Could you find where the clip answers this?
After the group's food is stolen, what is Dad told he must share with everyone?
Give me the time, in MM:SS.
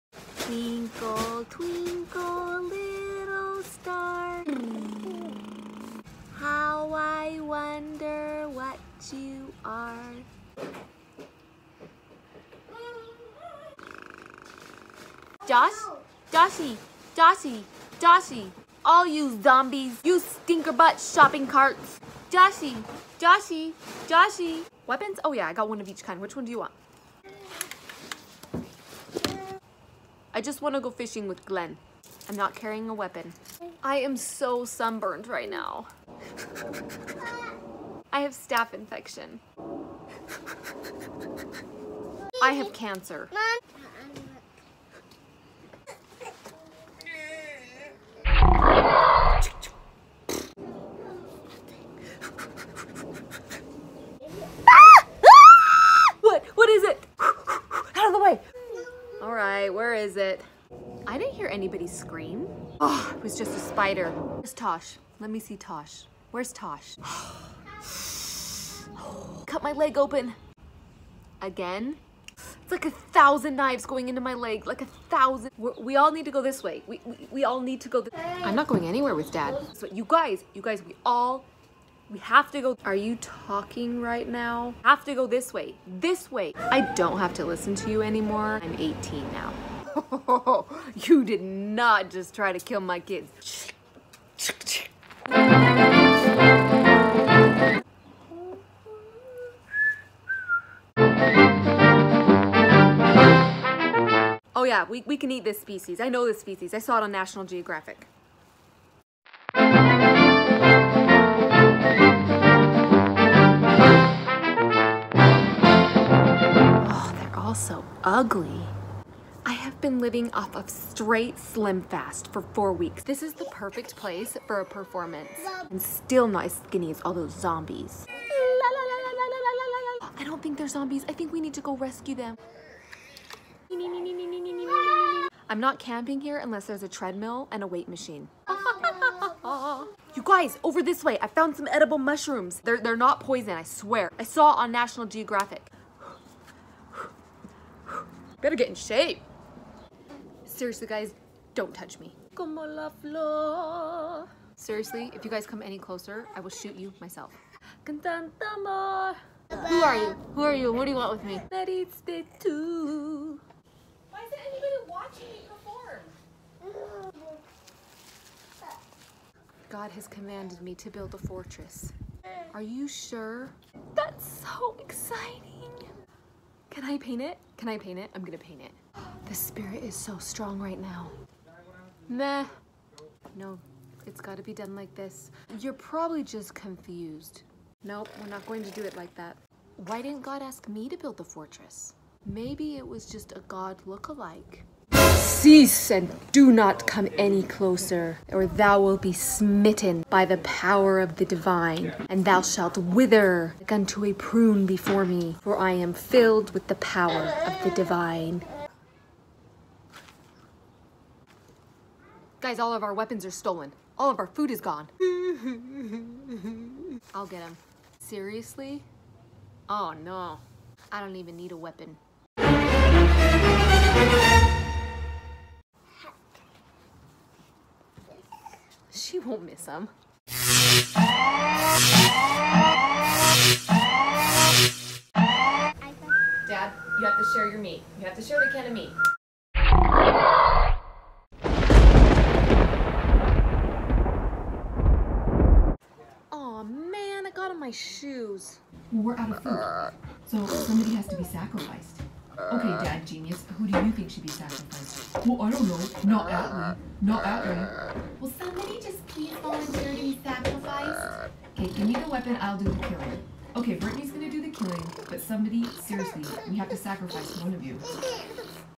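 03:58.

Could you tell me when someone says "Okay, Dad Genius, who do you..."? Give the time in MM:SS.
04:12.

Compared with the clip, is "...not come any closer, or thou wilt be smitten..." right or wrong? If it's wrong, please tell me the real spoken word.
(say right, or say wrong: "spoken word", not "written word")
right.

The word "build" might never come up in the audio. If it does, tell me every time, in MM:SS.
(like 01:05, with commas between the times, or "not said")
02:50, 03:10.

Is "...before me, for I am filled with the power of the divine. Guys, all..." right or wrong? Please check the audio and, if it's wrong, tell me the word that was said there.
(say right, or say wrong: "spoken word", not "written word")
right.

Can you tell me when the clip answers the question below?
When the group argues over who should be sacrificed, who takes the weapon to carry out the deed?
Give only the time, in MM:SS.
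04:23.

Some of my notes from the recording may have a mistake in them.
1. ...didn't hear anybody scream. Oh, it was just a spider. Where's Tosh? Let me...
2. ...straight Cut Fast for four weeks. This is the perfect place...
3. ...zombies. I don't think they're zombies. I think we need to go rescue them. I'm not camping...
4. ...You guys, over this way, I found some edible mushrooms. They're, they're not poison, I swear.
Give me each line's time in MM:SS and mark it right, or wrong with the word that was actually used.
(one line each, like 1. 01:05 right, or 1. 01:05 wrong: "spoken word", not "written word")
1. 01:01 right
2. 02:00 wrong: "Slim", not "Cut"
3. 02:07 right
4. 02:20 right.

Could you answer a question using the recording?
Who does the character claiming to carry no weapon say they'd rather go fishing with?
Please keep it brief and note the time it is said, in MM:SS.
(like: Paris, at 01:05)
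Glenn, at 00:31.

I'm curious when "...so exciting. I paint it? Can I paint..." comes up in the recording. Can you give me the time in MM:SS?
02:54.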